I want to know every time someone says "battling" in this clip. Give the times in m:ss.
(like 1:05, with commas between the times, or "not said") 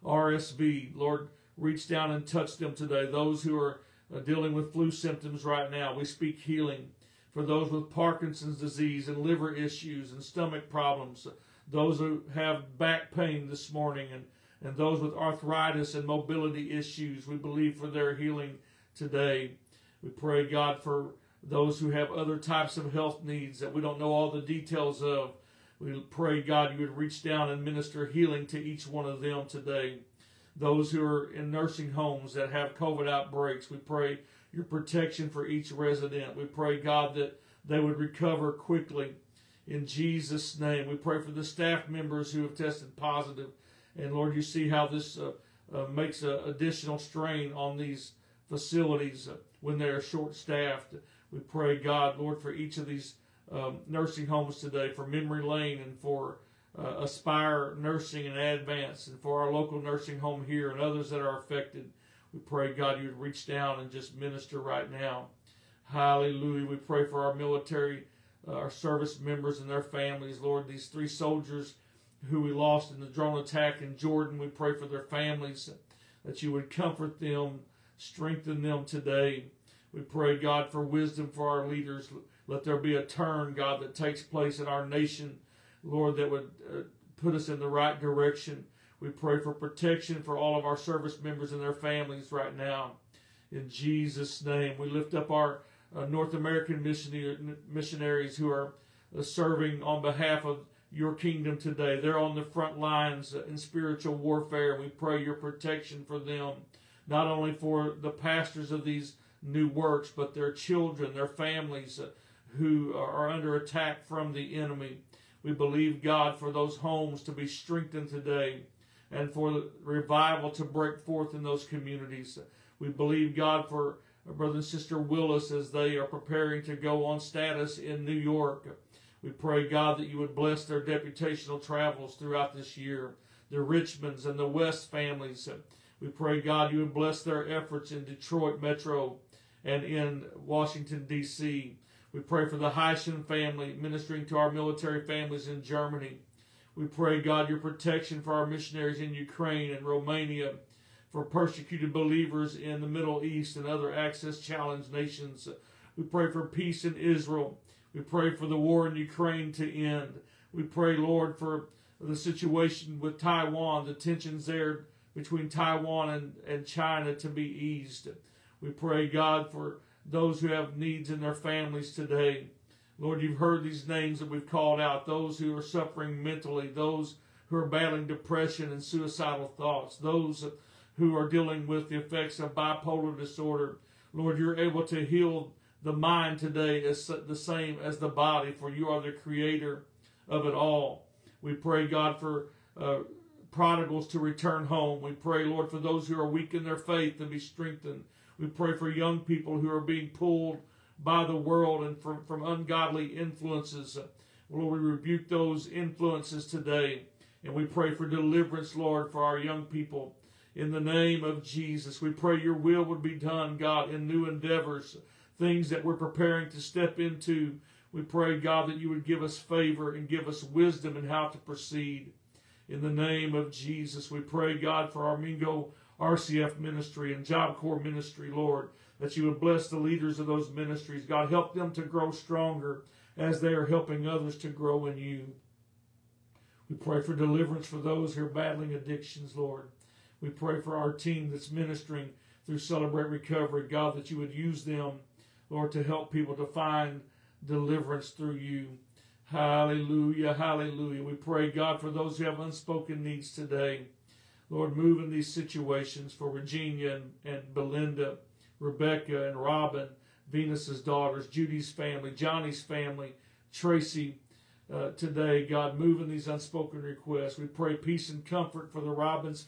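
2:57, 3:58.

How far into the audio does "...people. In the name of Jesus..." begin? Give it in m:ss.
3:29.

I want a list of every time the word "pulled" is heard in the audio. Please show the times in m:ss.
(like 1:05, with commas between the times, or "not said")
3:20.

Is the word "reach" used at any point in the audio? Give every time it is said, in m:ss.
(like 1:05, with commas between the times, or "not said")
0:01, 0:26, 1:03.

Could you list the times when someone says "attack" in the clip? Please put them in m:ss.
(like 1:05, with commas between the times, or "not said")
1:13, 1:53.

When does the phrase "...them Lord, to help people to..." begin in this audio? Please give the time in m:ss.
4:04.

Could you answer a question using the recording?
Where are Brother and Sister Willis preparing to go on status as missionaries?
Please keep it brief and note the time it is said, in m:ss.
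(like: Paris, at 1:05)
New York, at 2:08.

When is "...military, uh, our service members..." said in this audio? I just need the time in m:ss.
1:07.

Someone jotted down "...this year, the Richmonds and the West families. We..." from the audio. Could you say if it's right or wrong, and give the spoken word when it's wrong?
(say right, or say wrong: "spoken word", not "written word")
right.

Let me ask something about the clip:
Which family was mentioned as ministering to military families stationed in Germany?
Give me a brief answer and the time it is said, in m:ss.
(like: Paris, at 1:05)
Heishen, at 2:22.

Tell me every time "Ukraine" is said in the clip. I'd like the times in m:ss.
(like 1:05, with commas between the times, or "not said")
2:29, 2:38.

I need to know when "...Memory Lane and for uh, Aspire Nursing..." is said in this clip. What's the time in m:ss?
0:55.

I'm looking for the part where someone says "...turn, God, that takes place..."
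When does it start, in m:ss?
1:23.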